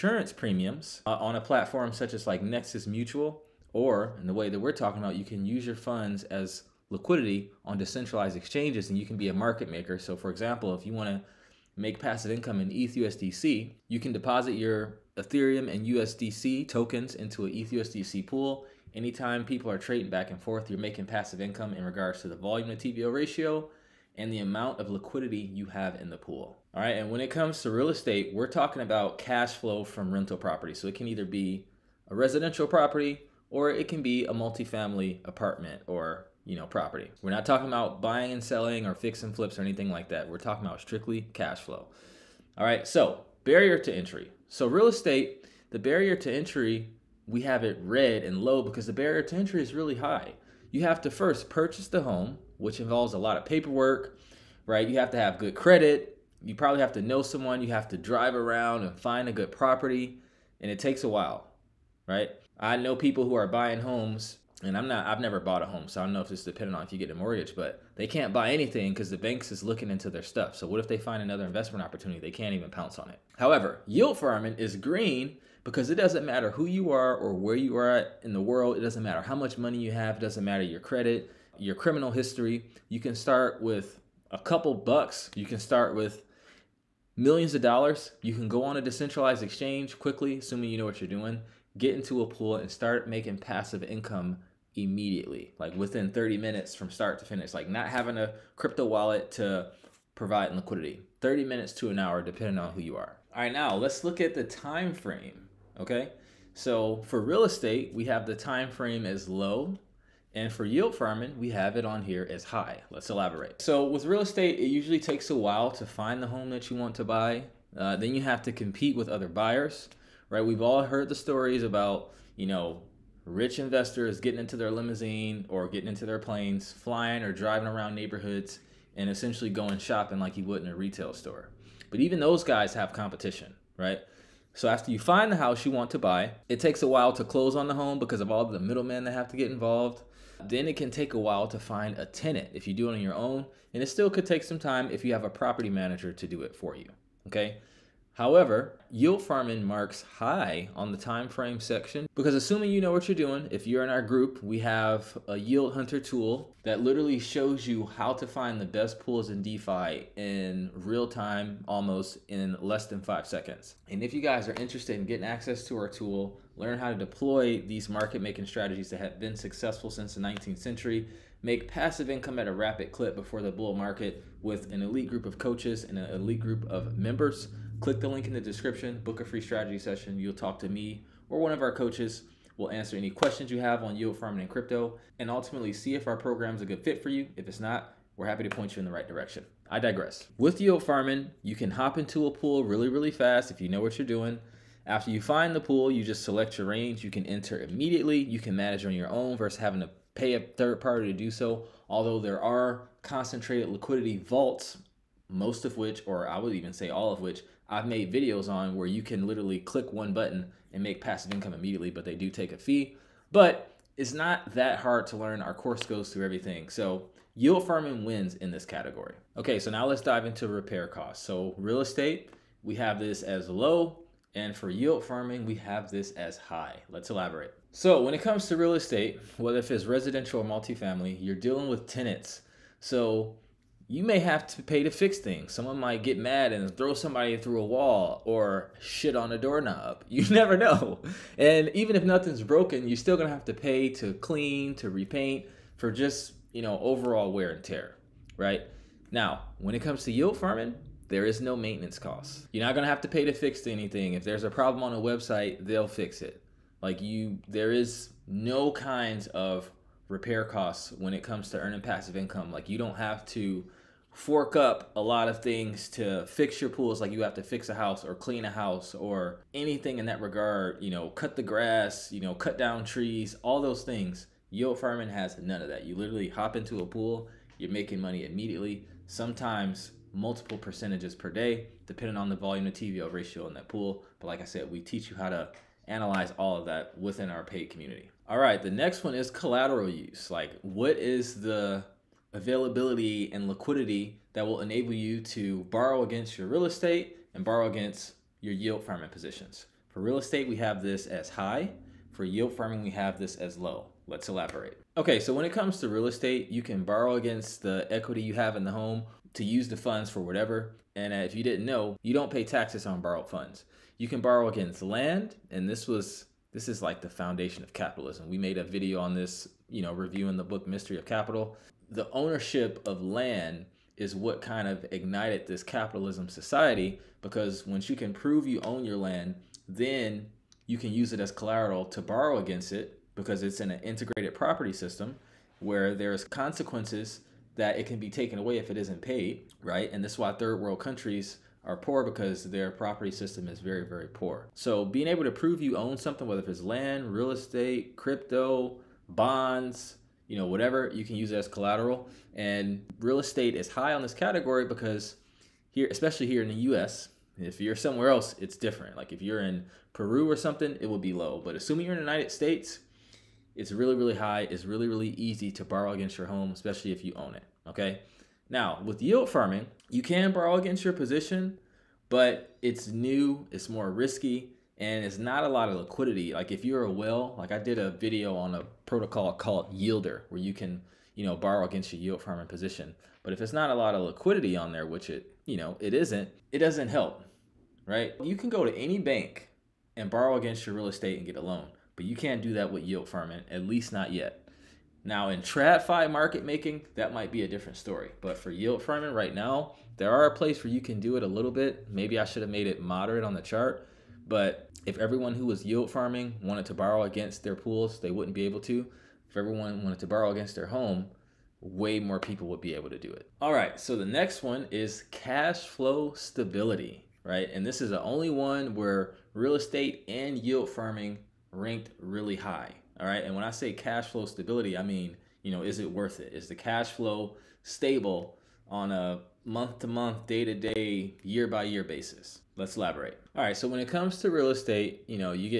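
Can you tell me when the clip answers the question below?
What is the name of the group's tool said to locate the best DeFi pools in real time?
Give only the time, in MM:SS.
02:35.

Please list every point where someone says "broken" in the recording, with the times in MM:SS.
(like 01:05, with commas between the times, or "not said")
04:02.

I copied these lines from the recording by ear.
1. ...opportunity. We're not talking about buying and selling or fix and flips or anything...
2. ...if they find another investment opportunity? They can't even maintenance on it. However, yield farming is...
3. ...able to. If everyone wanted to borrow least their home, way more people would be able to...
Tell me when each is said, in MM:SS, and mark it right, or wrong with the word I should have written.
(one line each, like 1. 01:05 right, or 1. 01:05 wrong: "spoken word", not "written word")
1. 00:36 wrong: "property", not "opportunity"
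2. 01:10 wrong: "pounce", not "maintenance"
3. 06:48 wrong: "against", not "least".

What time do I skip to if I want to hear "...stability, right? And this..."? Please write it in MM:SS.
06:56.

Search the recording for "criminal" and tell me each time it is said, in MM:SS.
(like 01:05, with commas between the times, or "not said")
01:21.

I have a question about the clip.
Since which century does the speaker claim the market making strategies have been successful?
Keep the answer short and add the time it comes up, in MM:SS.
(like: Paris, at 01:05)
19th century, at 02:50.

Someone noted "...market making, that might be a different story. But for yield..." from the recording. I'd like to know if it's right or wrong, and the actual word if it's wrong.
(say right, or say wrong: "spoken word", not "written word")
right.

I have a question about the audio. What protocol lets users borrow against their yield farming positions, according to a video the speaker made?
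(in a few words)
YLDR.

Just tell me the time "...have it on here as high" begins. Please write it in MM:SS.
01:51.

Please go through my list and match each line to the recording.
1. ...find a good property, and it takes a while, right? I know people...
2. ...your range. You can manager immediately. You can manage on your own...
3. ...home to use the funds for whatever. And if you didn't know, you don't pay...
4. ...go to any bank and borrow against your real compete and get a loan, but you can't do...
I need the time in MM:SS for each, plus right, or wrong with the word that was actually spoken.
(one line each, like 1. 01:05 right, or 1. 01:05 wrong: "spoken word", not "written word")
1. 00:58 right
2. 03:16 wrong: "enter", not "manager"
3. 05:08 right
4. 06:28 wrong: "estate", not "compete".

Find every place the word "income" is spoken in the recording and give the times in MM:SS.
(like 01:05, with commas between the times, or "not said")
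00:12, 00:21, 01:33, 02:52, 03:31, 04:22.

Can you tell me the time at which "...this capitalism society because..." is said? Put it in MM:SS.
05:25.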